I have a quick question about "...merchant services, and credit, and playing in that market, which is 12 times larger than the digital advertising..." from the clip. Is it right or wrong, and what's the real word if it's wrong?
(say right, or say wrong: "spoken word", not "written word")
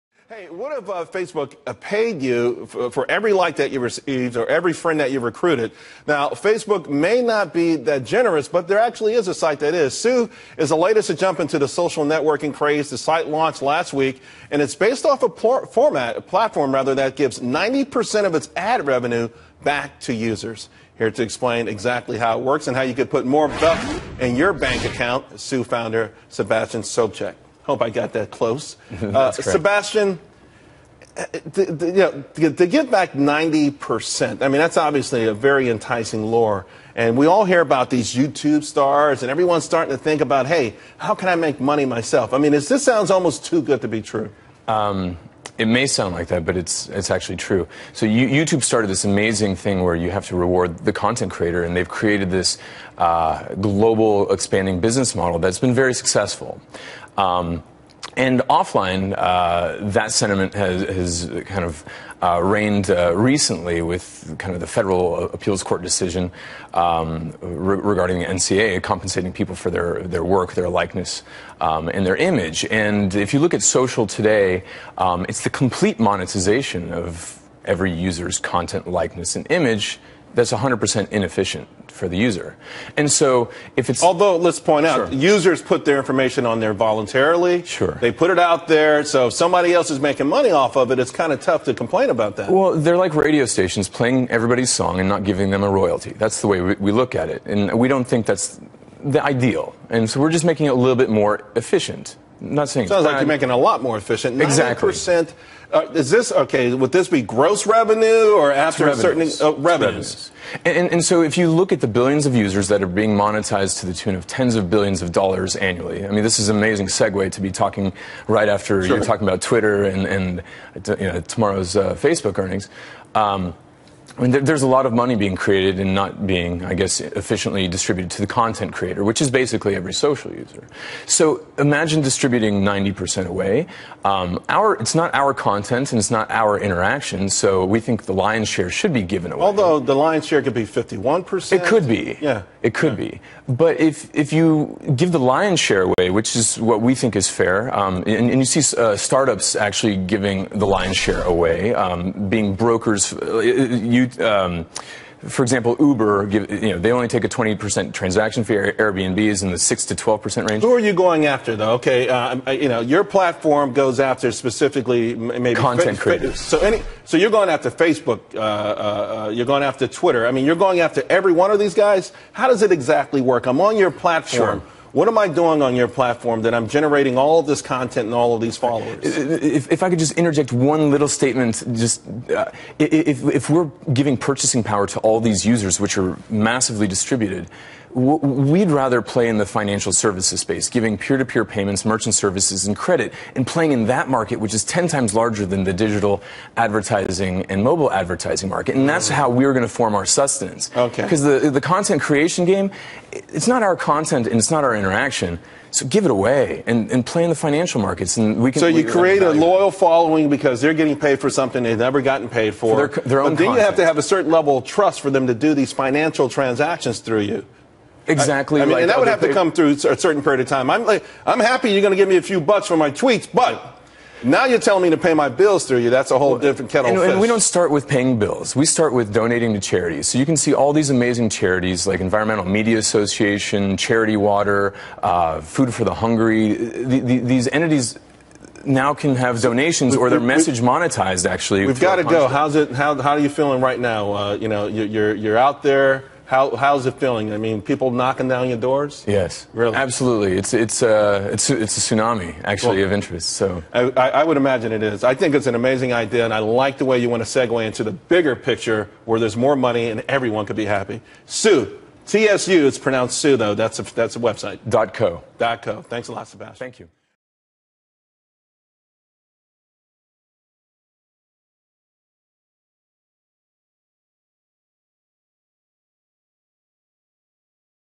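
wrong: "10", not "12".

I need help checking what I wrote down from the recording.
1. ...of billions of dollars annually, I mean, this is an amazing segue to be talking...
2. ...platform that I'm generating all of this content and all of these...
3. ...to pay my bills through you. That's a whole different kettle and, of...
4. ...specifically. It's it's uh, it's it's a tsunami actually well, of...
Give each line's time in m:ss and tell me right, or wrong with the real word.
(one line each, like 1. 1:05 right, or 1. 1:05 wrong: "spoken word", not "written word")
1. 1:54 right
2. 2:55 right
3. 3:44 right
4. 4:09 wrong: "absolutely", not "specifically".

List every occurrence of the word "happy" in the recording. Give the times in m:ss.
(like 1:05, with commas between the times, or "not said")
3:41, 4:20.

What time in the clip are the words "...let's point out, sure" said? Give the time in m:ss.
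1:24.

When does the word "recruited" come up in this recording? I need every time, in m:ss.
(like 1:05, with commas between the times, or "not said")
0:05.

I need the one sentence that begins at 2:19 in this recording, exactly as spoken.
Although the lion's share could be 51%.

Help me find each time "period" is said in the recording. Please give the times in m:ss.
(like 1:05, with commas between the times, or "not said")
3:40.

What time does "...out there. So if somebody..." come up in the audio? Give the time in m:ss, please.
1:28.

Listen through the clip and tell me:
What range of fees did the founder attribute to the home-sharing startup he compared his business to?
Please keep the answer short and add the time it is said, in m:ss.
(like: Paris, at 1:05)
6 to 12%, at 2:39.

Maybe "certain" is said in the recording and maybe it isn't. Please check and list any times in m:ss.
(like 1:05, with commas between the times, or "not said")
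1:48, 3:34, 3:39.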